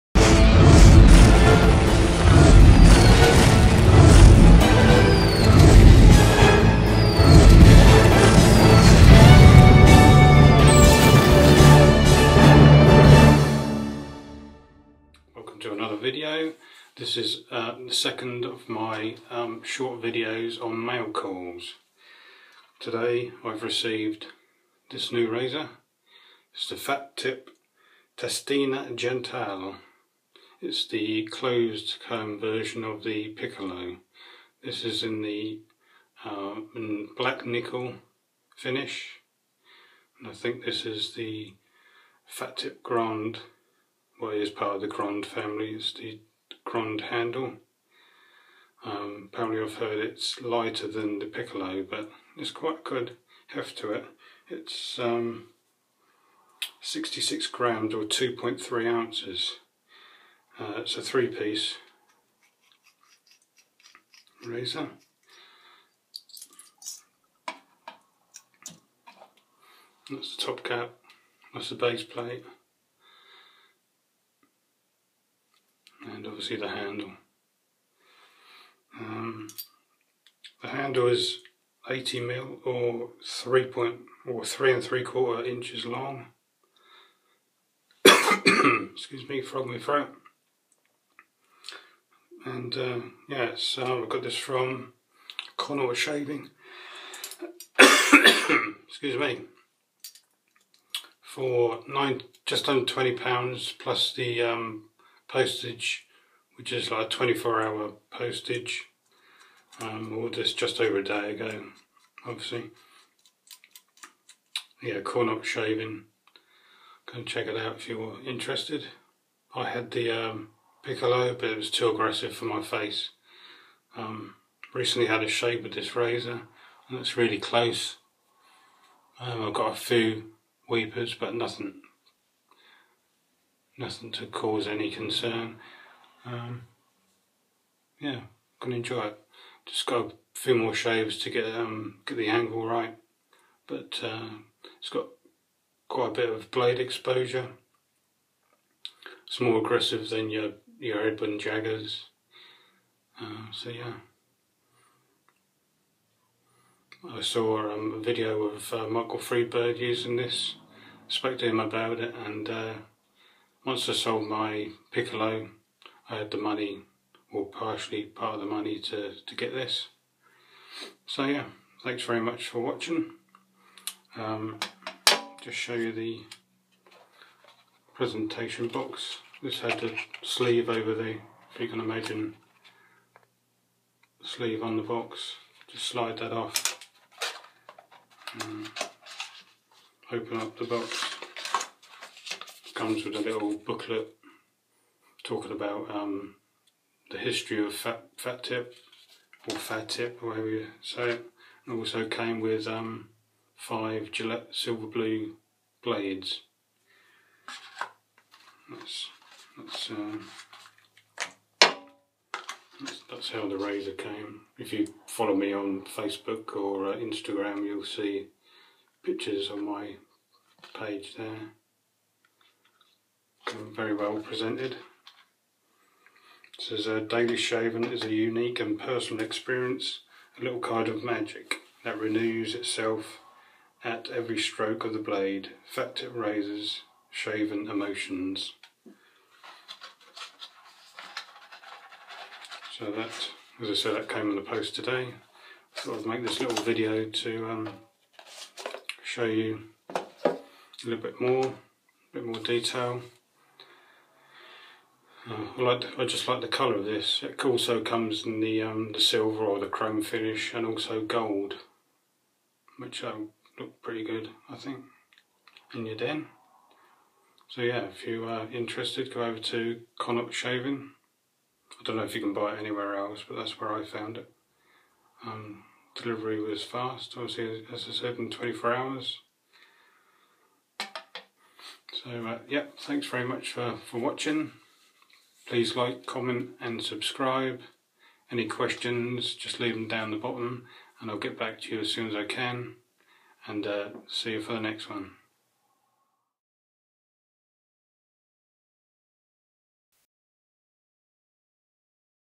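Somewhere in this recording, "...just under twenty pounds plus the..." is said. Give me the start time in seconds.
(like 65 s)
102 s.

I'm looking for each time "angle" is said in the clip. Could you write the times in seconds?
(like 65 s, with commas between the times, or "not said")
142 s.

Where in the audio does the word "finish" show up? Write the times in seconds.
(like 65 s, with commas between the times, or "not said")
38 s, 260 s.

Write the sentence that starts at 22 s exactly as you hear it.
Today I've received this new razor.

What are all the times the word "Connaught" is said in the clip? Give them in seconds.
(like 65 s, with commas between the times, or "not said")
95 s, 115 s, 269 s.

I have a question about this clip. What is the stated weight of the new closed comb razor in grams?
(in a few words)
66 grams.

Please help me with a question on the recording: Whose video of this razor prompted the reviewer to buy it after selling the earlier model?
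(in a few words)
Michael Freebird.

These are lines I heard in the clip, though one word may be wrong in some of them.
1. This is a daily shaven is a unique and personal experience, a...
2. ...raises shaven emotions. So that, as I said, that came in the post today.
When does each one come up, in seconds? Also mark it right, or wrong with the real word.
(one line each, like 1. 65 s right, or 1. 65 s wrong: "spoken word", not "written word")
1. 226 s right
2. 236 s right.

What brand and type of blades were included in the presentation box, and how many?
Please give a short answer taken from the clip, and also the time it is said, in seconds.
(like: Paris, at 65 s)
5 Gillette Silver Blue, at 203 s.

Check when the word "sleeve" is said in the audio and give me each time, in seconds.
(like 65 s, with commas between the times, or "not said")
180 s, 184 s.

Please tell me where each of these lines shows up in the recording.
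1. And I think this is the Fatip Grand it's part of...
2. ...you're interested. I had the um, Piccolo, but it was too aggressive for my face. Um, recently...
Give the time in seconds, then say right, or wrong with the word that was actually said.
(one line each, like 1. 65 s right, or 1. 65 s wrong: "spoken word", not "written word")
1. 40 s right
2. 117 s right.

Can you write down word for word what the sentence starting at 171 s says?
So yeah, thanks very much for watching.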